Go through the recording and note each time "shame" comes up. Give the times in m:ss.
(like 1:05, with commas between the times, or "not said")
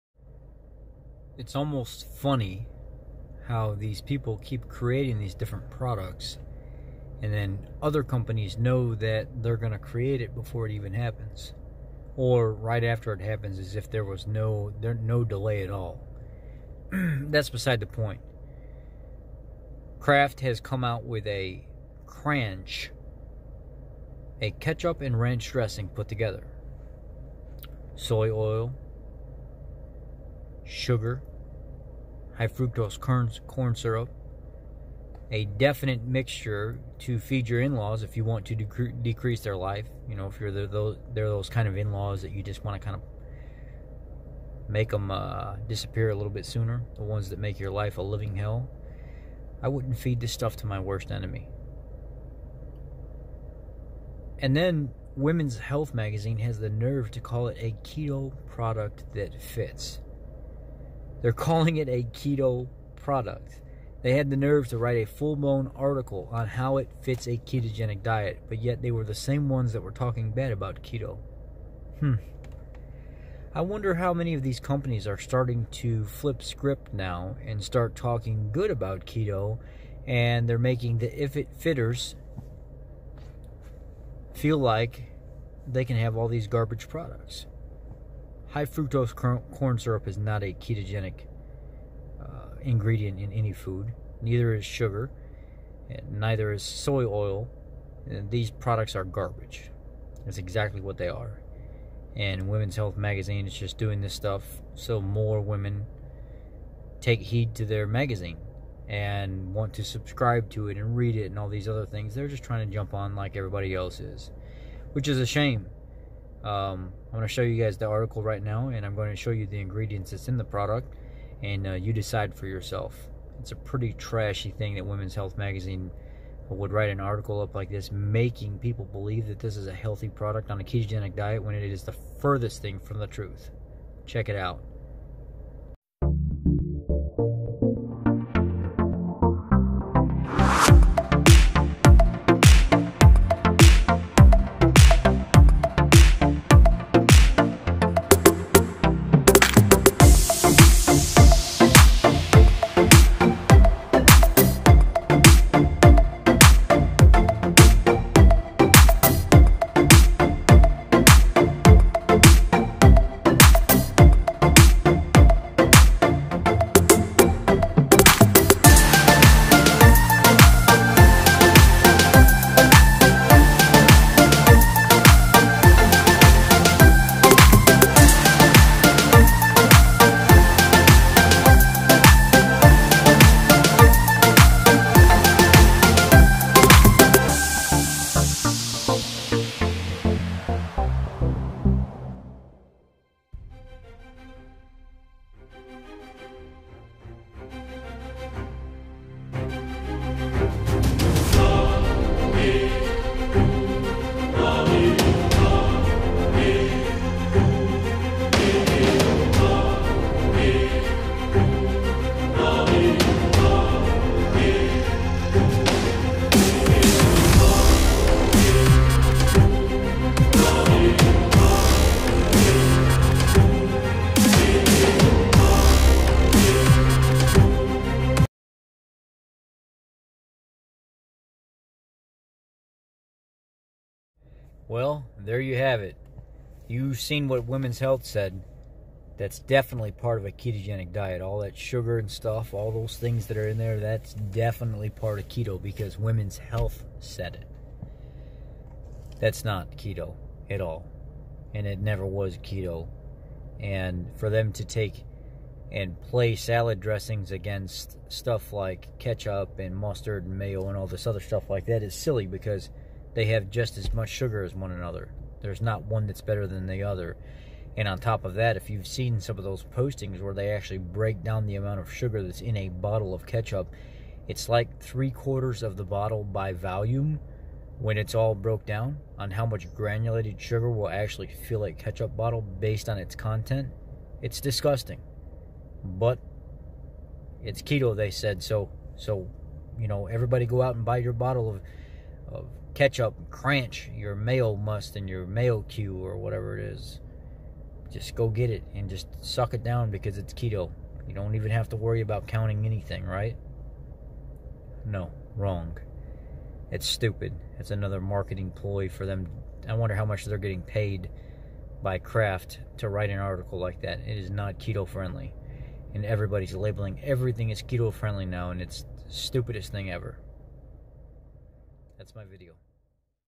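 1:55.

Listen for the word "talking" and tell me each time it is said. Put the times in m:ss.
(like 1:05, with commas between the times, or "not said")
1:09, 1:17.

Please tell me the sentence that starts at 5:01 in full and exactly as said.
You don't even have to worry about counting anything, right?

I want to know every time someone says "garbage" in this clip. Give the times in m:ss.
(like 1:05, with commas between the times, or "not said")
1:26, 1:39.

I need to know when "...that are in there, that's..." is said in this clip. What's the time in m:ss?
4:03.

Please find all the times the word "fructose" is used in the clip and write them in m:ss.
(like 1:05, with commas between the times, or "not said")
0:32, 1:28.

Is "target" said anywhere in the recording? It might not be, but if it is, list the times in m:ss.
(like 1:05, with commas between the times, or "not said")
not said.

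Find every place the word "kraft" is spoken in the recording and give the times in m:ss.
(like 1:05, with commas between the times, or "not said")
0:19, 5:11.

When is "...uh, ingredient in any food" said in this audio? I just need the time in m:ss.
1:32.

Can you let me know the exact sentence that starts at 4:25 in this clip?
There's not one that's better than the other.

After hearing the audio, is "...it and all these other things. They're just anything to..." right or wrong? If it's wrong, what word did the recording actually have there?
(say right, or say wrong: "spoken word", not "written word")
wrong: "trying", not "anything".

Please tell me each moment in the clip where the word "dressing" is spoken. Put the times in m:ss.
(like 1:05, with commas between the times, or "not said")
0:25, 4:16.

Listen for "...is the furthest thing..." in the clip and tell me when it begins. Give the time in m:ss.
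2:11.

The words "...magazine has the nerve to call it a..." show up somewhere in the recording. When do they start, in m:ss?
0:55.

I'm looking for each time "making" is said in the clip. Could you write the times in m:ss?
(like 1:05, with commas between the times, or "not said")
1:20, 2:07.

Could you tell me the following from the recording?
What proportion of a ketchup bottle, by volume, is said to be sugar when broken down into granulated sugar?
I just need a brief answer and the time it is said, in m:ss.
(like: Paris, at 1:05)
three quarters, at 4:34.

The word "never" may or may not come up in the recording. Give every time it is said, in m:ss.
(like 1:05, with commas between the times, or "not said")
4:11.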